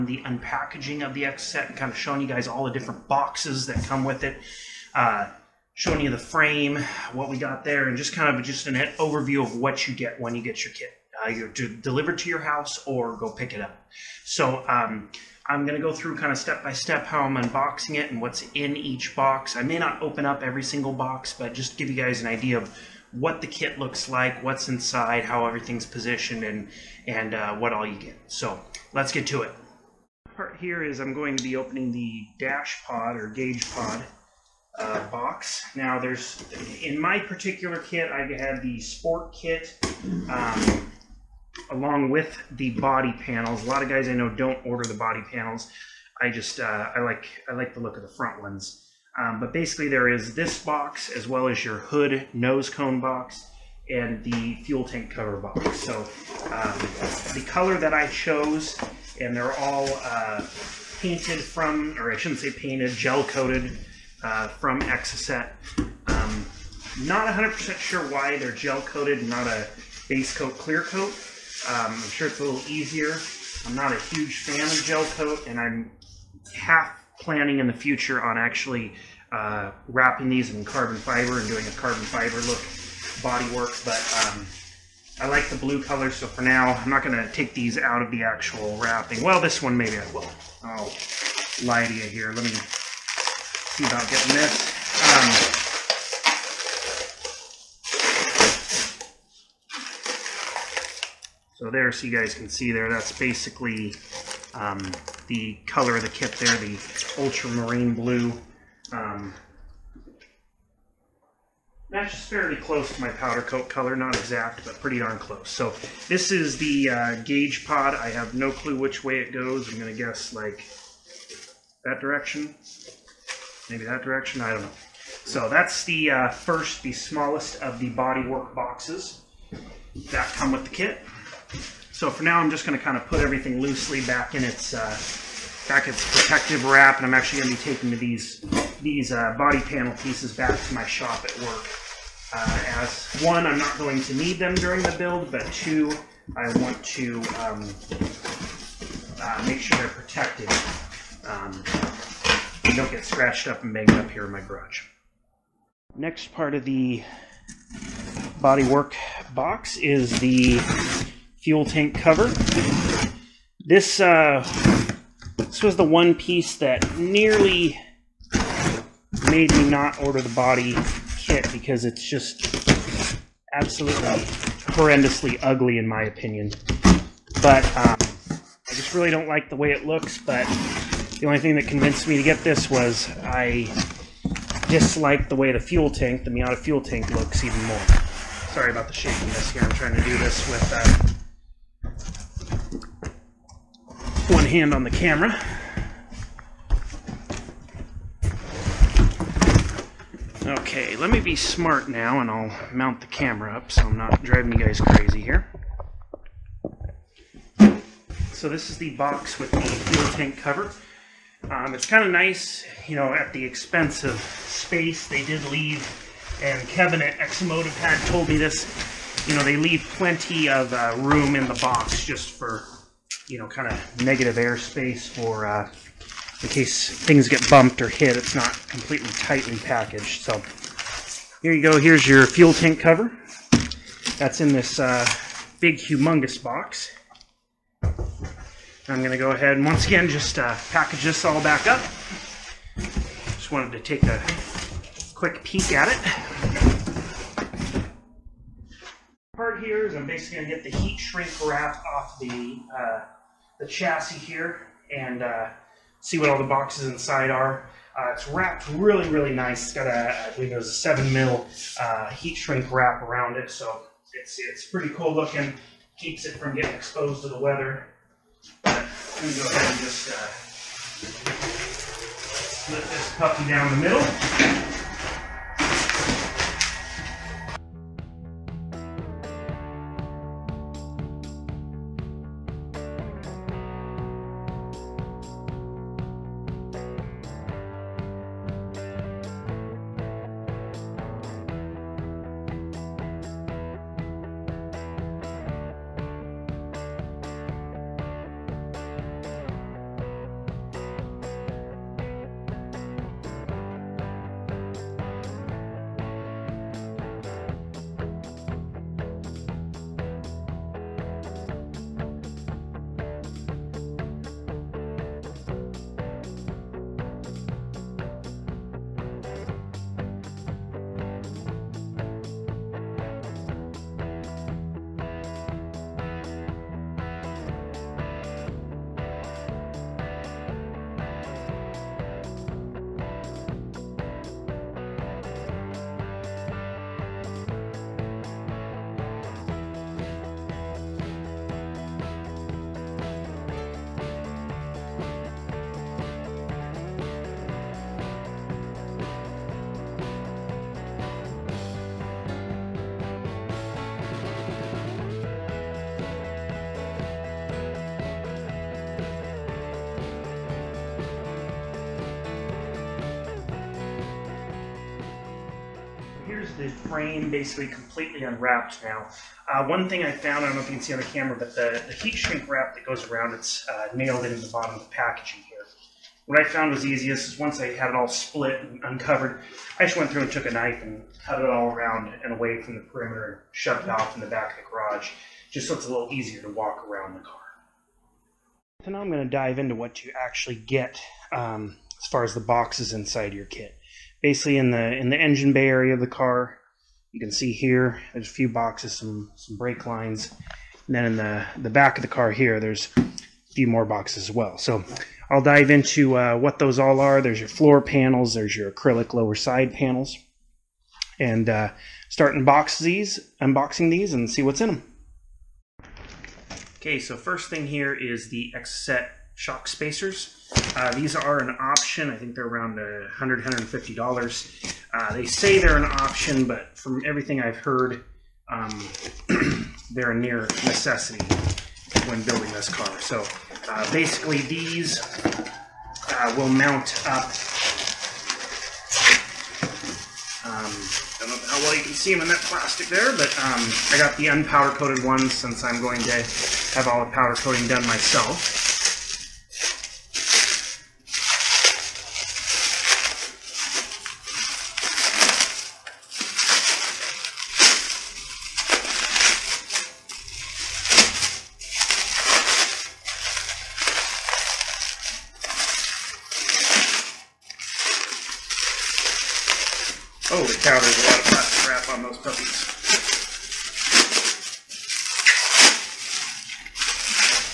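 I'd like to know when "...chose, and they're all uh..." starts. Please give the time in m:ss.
0:58.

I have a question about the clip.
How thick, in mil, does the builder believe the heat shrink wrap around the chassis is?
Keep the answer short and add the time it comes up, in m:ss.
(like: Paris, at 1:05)
7 mil, at 4:20.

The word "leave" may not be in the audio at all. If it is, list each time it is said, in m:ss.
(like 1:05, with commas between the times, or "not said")
3:35, 3:39.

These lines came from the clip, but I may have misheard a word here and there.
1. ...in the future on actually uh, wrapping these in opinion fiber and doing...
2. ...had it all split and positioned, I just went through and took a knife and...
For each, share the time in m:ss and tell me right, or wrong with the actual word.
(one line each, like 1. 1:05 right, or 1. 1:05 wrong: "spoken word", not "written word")
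1. 1:17 wrong: "carbon", not "opinion"
2. 6:17 wrong: "uncovered", not "positioned".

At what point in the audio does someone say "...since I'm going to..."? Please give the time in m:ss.
7:25.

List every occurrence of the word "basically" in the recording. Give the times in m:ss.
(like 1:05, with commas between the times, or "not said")
0:49, 1:43, 4:10, 6:07, 6:34, 7:13.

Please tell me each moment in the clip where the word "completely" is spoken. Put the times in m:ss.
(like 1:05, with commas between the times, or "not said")
3:48, 6:07.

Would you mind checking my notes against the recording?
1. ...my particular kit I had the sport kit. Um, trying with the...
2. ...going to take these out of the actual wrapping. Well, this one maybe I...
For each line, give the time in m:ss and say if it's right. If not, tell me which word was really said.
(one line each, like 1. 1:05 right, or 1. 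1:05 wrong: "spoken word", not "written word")
1. 0:36 wrong: "along", not "trying"
2. 1:27 right.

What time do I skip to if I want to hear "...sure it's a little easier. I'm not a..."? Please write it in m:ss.
1:12.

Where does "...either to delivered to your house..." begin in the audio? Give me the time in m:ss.
0:11.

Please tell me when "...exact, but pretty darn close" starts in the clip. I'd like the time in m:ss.
1:54.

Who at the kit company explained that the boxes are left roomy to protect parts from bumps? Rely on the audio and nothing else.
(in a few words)
Kevin.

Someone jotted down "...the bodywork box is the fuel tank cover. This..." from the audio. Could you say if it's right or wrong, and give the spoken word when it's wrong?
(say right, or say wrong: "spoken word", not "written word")
right.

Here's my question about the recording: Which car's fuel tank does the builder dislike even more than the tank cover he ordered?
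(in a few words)
Miata.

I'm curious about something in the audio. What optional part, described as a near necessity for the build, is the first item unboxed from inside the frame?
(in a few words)
shock spacers.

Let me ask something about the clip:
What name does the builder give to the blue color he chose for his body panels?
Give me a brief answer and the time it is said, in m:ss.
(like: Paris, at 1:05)
ultramarine blue, at 1:47.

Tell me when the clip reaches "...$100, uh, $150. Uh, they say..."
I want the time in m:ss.
7:02.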